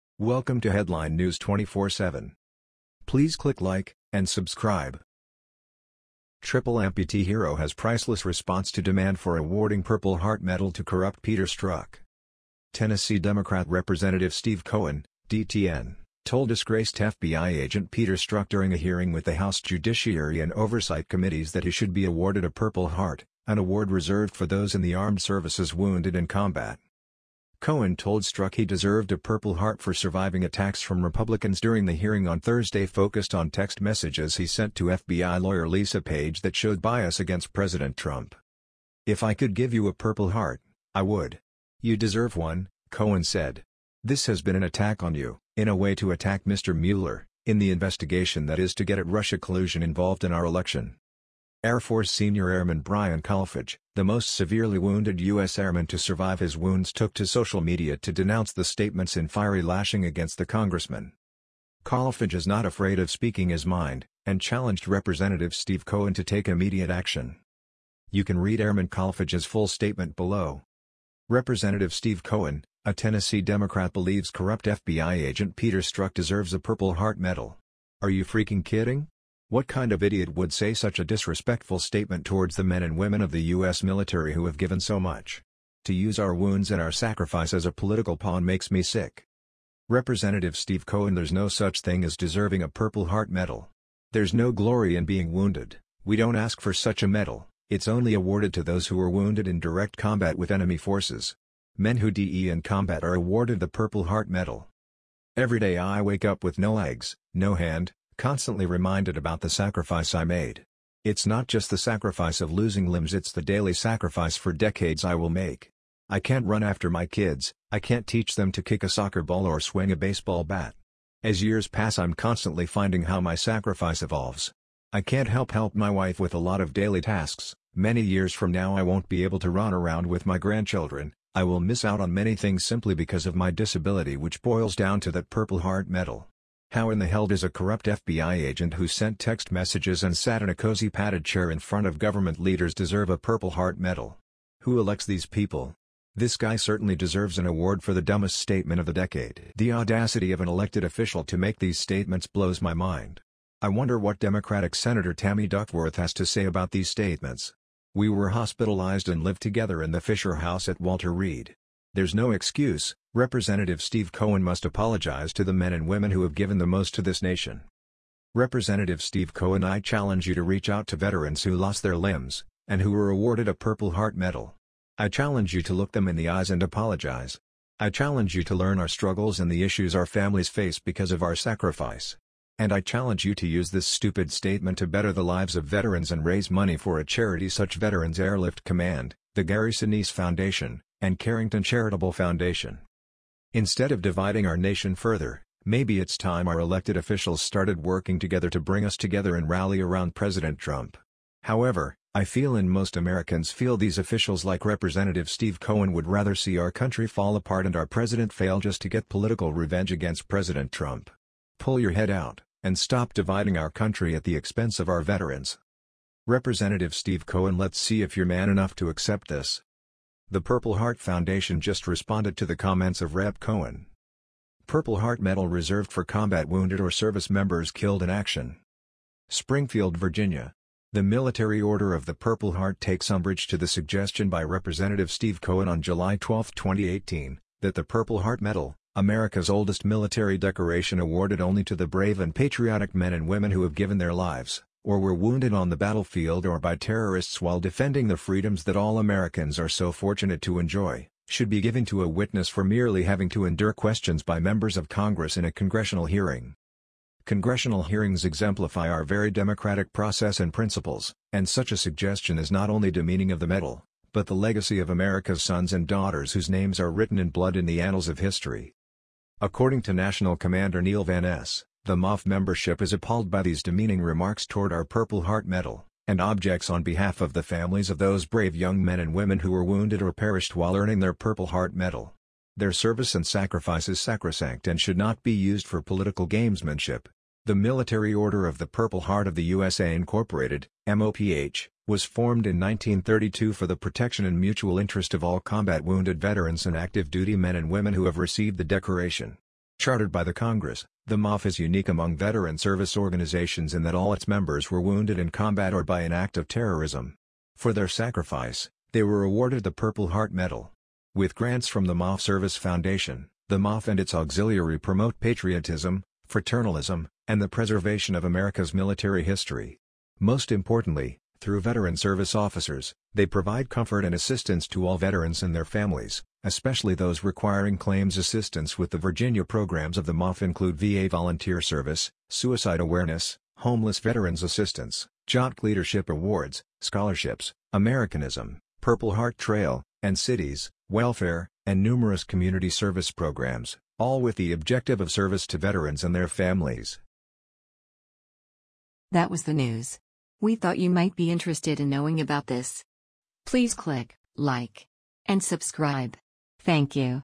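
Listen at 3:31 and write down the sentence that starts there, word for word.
Pull your head out, and stop dividing our country at the expense of our veterans.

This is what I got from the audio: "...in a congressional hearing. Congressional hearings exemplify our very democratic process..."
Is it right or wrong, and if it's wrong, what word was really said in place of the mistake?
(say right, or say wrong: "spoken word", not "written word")
right.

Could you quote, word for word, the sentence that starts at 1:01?
Kolfage is not afraid of speaking his mind, and challenged Representative Steve Cohen to take immediate action.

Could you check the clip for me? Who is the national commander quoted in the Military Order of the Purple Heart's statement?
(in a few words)
Neil Van Ess.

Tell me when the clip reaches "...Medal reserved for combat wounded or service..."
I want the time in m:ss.
3:45.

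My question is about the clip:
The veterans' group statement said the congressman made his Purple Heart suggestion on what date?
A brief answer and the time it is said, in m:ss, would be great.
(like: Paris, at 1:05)
July 12, 2018, at 3:55.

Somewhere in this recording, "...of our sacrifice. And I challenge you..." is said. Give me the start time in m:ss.
3:01.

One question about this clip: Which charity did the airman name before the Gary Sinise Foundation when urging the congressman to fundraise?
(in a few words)
Veterans Airlift Command.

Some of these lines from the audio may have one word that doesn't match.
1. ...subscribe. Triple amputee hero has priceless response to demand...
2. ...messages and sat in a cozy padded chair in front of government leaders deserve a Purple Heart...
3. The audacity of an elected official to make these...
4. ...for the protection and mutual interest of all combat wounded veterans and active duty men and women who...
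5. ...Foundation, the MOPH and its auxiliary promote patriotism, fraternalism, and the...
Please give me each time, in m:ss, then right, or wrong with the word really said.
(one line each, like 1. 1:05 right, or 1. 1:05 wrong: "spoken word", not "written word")
1. 0:04 right
2. 2:19 right
3. 2:29 right
4. 4:53 right
5. 5:12 right.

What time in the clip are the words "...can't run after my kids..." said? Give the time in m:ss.
1:56.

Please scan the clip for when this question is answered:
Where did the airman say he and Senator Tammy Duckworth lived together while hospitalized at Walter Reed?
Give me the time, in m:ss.
2:39.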